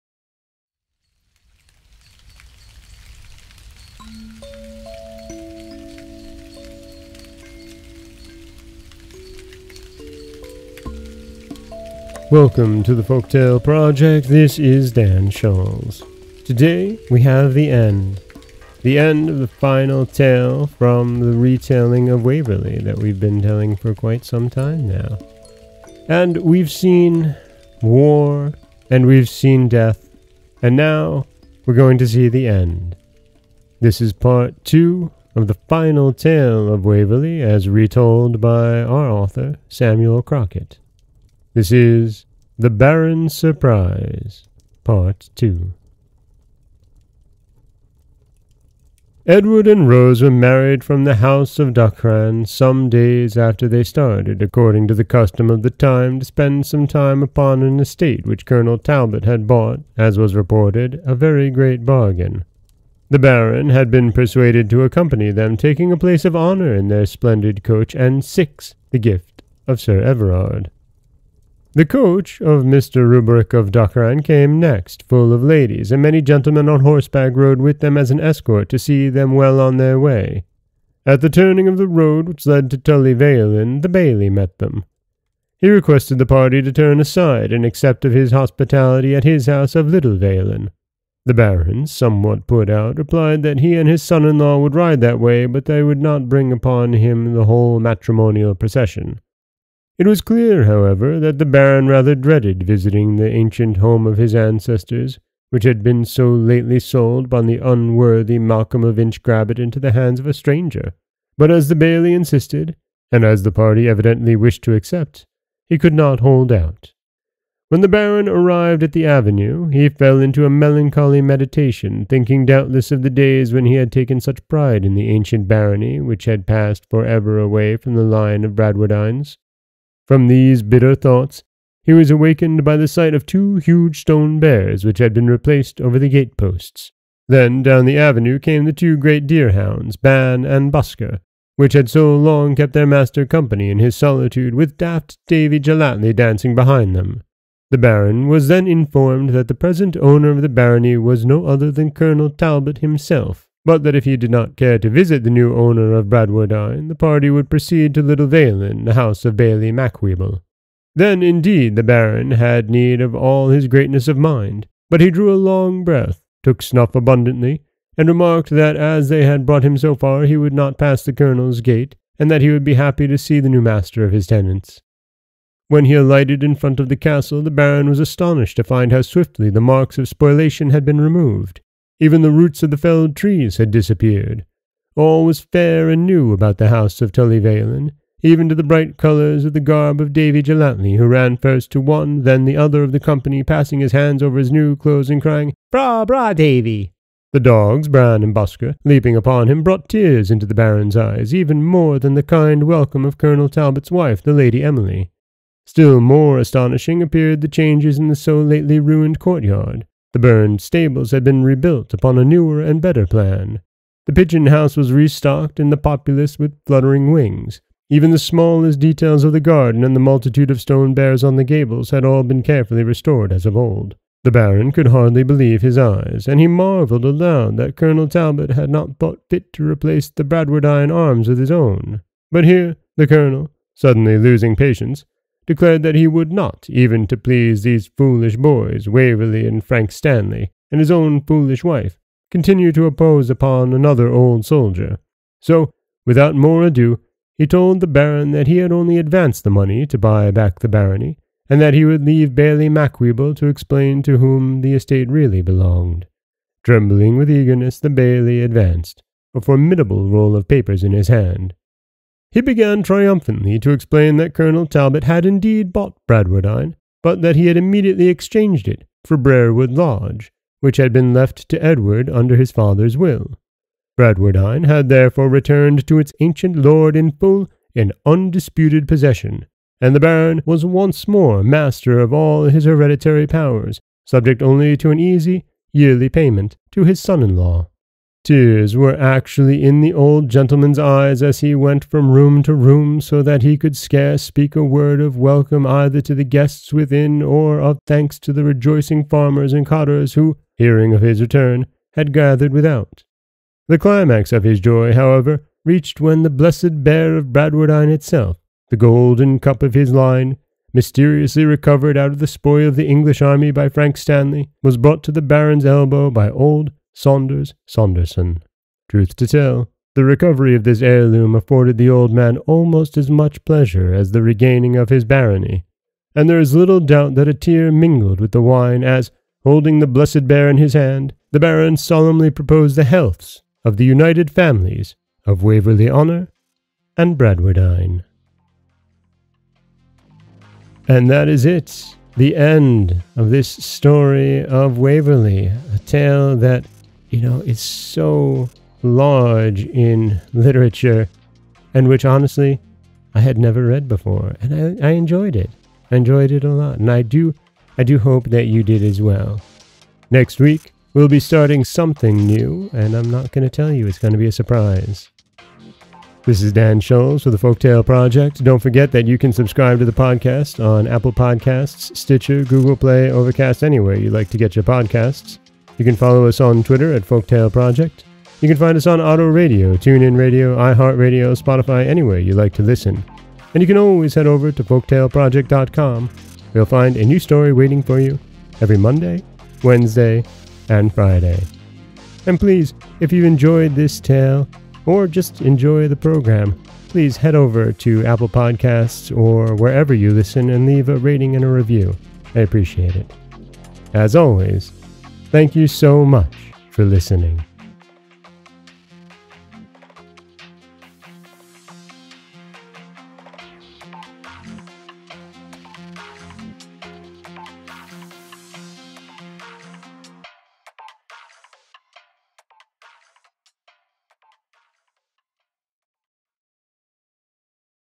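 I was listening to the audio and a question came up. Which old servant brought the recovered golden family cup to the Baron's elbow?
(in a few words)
Saunders Saunderson.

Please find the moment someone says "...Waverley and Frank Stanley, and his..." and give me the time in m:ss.
3:58.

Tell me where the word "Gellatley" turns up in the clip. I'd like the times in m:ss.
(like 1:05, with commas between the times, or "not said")
2:25, 3:10.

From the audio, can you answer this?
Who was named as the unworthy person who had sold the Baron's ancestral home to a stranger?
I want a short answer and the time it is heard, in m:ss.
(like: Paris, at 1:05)
Malcolm of Inchgrabbit, at 1:48.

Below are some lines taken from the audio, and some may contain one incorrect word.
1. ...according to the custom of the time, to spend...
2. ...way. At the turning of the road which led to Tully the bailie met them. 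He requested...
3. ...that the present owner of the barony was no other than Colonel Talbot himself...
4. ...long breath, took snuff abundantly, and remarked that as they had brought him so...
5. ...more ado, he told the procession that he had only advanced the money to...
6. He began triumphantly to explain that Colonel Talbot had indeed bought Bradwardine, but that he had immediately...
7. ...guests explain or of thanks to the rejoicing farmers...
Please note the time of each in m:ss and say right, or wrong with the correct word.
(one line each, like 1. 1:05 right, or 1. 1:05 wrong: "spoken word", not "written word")
1. 0:54 right
2. 1:19 right
3. 2:29 right
4. 2:45 right
5. 4:06 wrong: "baron", not "procession"
6. 4:22 right
7. 4:56 wrong: "within", not "explain".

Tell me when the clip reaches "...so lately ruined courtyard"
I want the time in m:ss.
3:28.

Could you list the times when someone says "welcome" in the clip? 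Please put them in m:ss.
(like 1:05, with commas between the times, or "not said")
0:12, 3:22, 4:55.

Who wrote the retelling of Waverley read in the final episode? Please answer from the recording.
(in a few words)
Samuel Crockett.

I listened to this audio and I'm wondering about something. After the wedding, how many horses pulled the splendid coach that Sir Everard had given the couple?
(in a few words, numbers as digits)
6.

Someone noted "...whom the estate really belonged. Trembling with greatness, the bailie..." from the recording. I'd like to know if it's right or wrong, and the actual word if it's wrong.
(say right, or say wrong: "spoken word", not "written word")
wrong: "eagerness", not "greatness".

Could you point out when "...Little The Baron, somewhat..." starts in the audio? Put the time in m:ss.
1:29.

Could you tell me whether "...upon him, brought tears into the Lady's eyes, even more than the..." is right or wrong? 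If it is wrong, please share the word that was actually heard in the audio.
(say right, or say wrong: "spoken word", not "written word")
wrong: "Baron", not "Lady".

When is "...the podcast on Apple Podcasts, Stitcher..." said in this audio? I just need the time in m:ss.
6:09.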